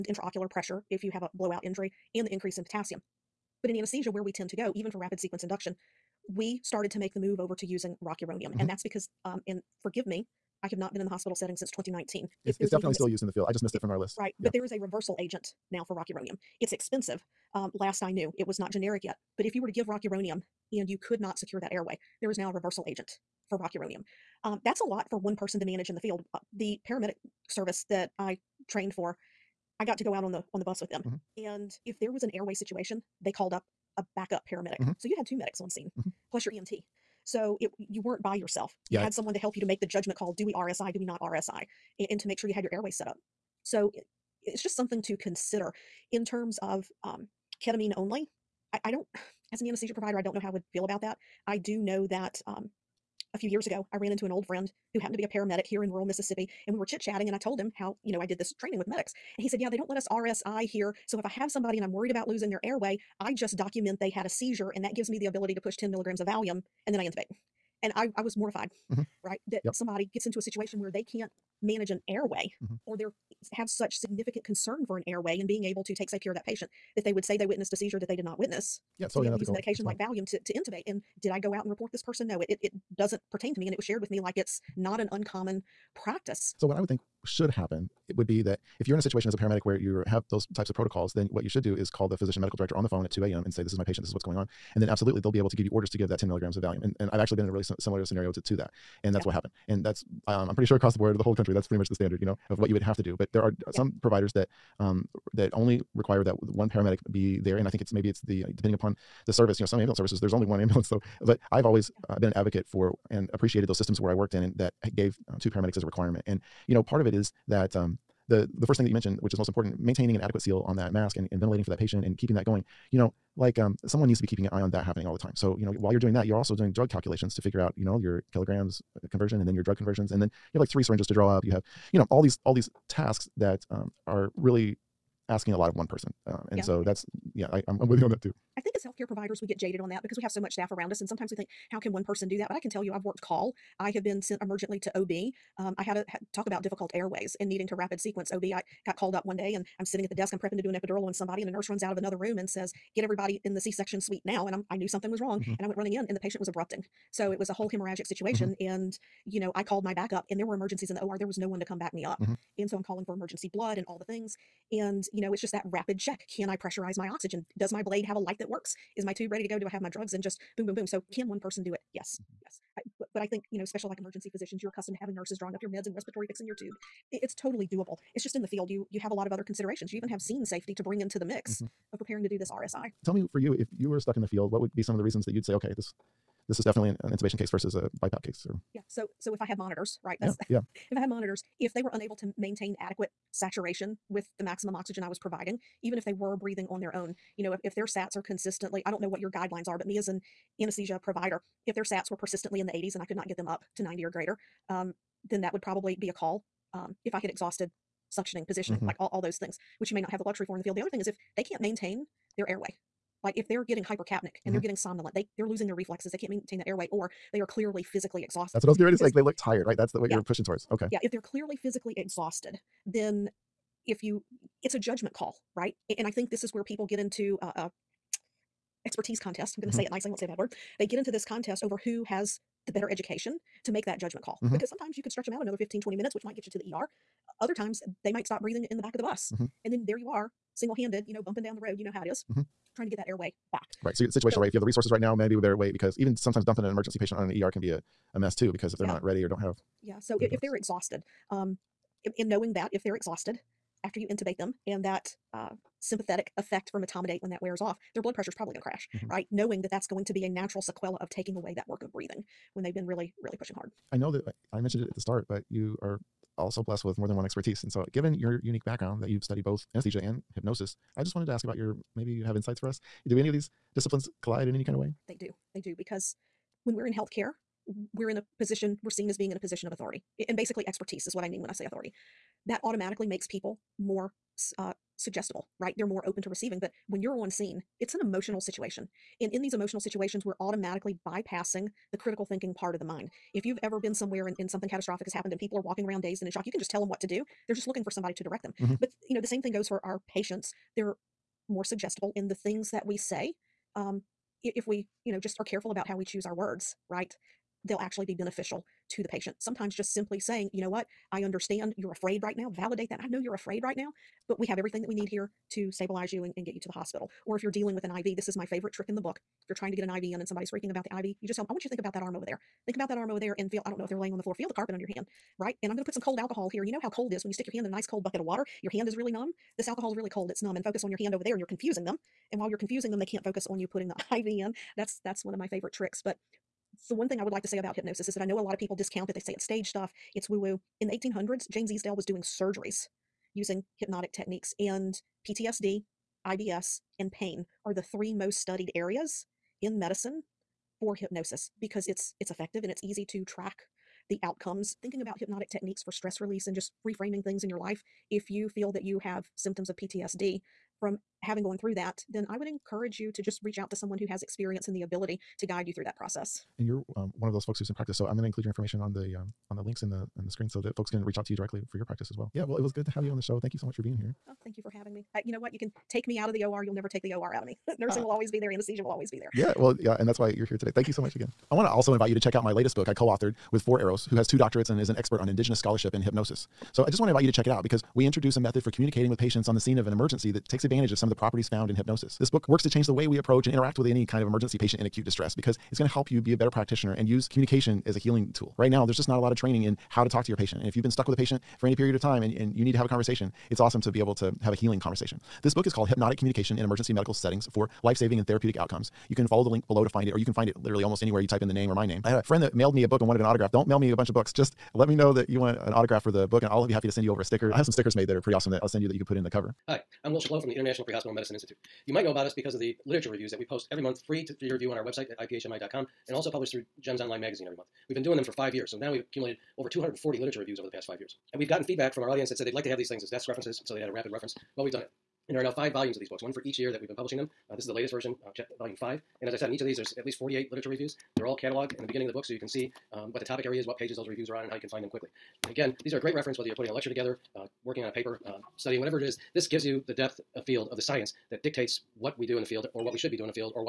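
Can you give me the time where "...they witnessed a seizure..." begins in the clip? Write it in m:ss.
1:17.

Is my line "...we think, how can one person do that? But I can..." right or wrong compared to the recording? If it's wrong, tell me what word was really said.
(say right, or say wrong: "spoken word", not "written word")
right.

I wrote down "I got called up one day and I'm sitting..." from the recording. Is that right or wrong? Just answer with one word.
right.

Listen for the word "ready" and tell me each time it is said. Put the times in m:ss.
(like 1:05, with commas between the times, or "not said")
2:49, 3:38, 4:09.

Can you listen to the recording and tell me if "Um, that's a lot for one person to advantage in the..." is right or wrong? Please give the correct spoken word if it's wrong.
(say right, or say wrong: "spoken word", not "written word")
wrong: "manage", not "advantage".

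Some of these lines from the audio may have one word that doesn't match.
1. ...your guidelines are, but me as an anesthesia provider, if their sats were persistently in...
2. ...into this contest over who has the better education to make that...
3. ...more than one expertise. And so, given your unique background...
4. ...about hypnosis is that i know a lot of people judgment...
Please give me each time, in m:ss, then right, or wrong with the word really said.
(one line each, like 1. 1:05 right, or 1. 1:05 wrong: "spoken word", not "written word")
1. 3:19 right
2. 3:50 right
3. 4:26 right
4. 5:37 wrong: "discount", not "judgment".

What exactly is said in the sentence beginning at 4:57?
They're just looking for somebody to direct them.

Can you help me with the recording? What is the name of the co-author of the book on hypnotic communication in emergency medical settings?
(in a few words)
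Four Arrows.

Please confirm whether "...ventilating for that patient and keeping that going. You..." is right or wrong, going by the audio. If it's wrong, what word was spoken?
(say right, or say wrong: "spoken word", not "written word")
right.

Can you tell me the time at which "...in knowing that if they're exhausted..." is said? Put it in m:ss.
4:12.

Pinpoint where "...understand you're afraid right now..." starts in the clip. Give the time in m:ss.
5:11.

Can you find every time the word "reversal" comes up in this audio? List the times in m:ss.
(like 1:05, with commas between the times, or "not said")
0:14, 0:22.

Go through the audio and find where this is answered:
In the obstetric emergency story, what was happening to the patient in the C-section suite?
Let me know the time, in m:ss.
2:36.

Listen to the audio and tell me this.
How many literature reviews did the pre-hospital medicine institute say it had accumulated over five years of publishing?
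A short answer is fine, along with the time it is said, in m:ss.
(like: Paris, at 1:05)
over 240, at 7:09.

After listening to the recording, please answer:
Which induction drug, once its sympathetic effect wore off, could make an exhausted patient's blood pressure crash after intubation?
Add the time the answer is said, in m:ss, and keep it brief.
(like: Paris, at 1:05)
etomidate, at 4:16.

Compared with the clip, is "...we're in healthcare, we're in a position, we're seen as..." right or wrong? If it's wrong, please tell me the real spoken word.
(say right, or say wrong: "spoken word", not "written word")
right.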